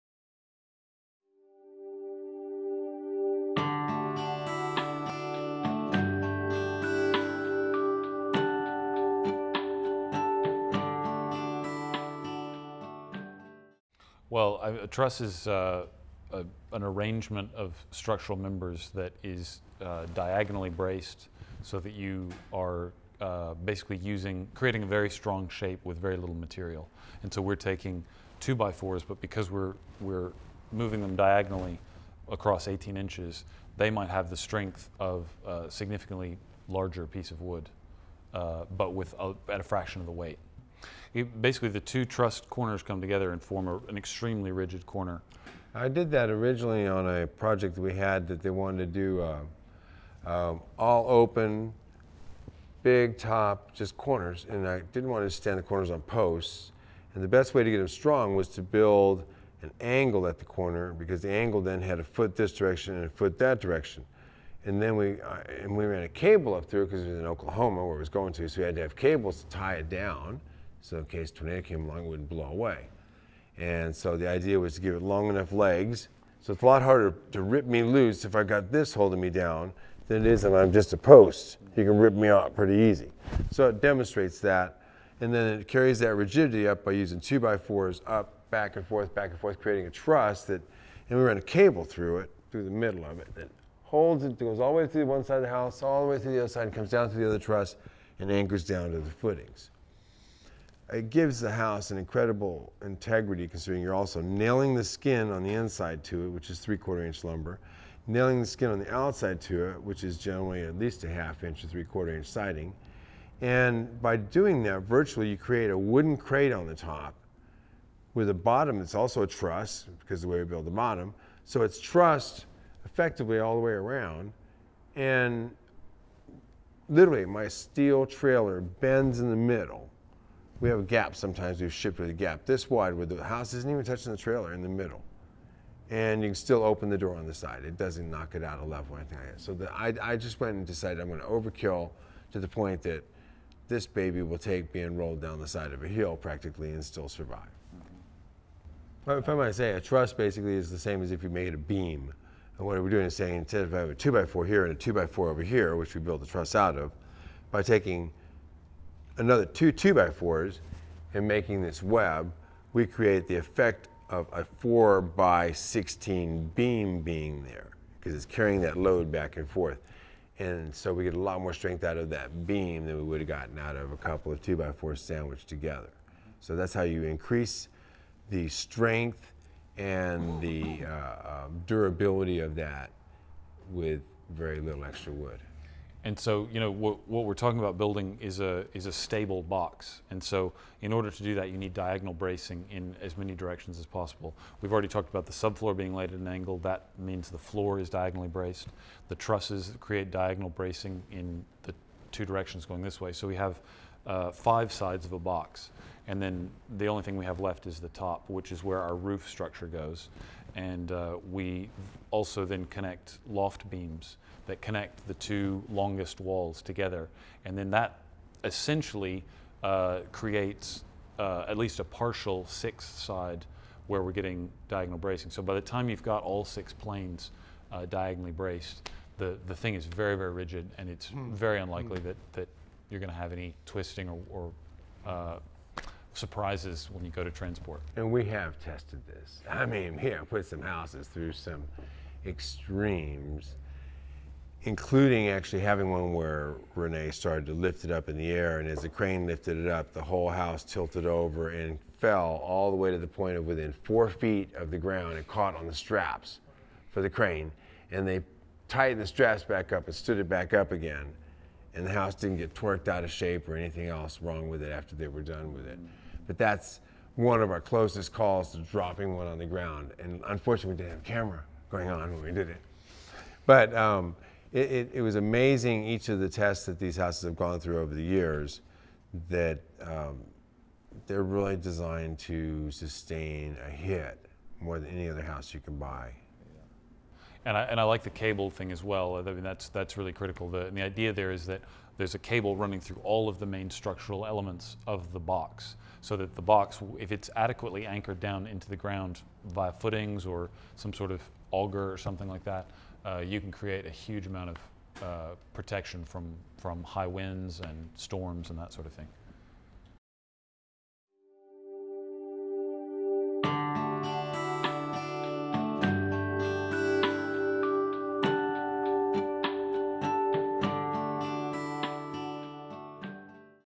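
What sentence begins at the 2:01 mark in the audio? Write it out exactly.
So it's trussed effectively all the way around.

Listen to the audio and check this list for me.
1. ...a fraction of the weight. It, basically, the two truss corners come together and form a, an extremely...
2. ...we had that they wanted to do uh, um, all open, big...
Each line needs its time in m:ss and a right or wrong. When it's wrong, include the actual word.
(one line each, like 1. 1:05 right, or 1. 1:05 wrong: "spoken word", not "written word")
1. 0:39 right
2. 0:47 right.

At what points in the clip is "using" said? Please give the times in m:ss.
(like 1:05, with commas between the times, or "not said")
0:23, 1:26.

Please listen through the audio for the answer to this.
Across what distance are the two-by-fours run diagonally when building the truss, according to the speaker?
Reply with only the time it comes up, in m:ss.
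0:32.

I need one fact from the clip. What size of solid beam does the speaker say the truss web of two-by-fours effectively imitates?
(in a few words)
4 by 16.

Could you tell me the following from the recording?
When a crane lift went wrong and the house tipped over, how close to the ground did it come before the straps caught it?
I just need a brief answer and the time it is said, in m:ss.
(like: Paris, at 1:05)
4 feet, at 4:13.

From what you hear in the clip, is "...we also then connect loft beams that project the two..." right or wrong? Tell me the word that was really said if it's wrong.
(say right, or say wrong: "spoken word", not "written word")
wrong: "connect", not "project".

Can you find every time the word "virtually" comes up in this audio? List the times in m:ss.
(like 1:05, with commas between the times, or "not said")
1:54.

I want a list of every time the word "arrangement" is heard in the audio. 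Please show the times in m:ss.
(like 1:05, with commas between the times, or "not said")
0:16.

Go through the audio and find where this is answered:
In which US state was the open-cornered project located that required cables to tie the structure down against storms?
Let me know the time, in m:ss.
1:07.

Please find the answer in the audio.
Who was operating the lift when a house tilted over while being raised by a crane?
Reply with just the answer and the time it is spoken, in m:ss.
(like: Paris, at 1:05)
Renee, at 4:06.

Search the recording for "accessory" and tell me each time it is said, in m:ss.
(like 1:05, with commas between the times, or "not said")
not said.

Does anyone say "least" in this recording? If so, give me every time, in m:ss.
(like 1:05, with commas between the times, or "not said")
1:50, 3:41.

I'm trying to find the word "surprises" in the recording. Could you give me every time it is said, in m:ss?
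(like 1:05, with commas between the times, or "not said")
3:56.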